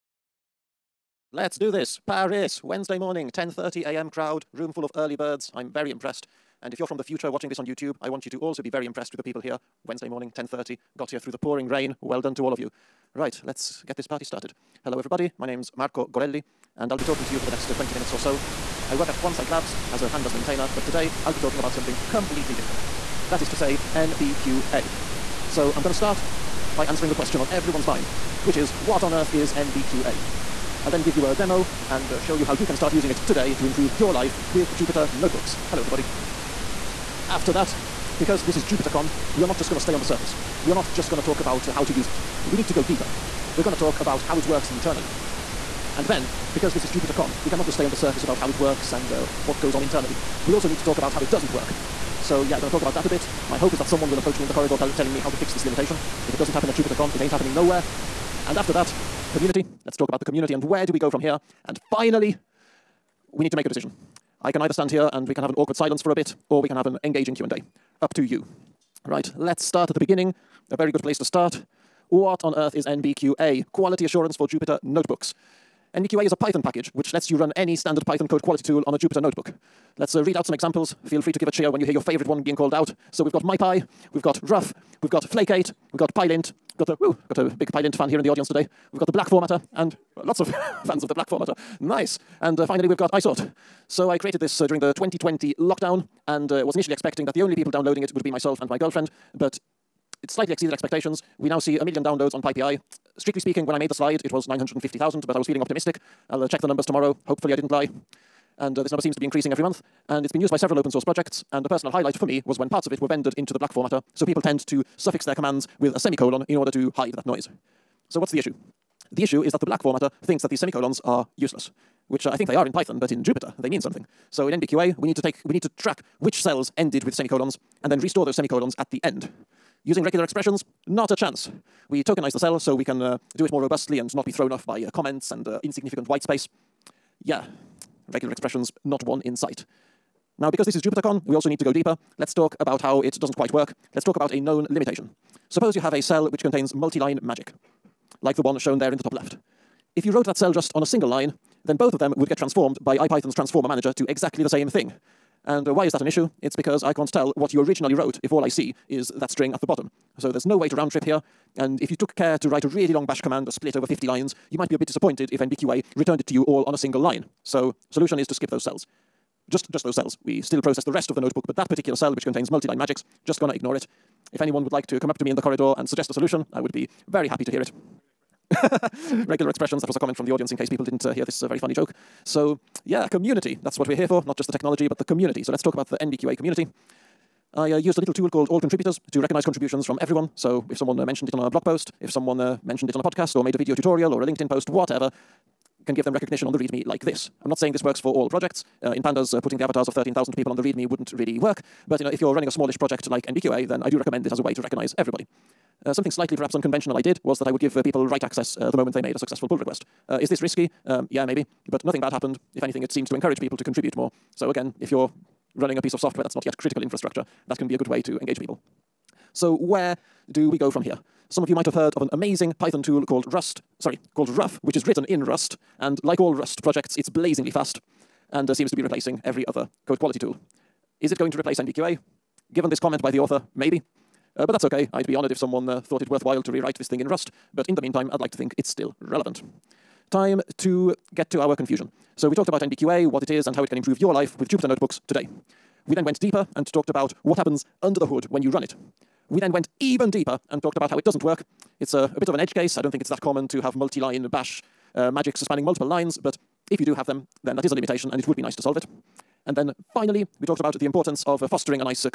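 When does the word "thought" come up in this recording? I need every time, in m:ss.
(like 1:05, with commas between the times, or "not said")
3:55.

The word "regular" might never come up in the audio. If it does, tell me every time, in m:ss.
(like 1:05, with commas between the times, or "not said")
2:10, 2:18, 2:59.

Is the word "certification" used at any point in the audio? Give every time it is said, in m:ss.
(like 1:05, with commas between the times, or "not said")
not said.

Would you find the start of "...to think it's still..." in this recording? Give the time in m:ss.
3:58.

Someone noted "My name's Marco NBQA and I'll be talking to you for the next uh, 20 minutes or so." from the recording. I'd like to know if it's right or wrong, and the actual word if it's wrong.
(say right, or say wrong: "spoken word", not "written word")
wrong: "Gorelli", not "NBQA".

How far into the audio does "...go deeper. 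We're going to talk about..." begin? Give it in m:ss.
0:42.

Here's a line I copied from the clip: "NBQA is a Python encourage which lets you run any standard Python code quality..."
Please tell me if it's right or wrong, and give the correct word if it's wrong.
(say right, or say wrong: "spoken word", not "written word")
wrong: "package", not "encourage".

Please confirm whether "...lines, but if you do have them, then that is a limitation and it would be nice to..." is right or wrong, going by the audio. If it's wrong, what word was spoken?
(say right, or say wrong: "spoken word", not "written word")
right.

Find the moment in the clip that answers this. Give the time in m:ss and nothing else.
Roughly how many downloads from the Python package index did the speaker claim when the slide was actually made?
1:44.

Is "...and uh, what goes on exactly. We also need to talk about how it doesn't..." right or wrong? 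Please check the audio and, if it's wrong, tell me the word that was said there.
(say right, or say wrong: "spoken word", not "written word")
wrong: "internally", not "exactly".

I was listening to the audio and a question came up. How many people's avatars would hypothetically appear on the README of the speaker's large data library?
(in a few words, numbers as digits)
13,000.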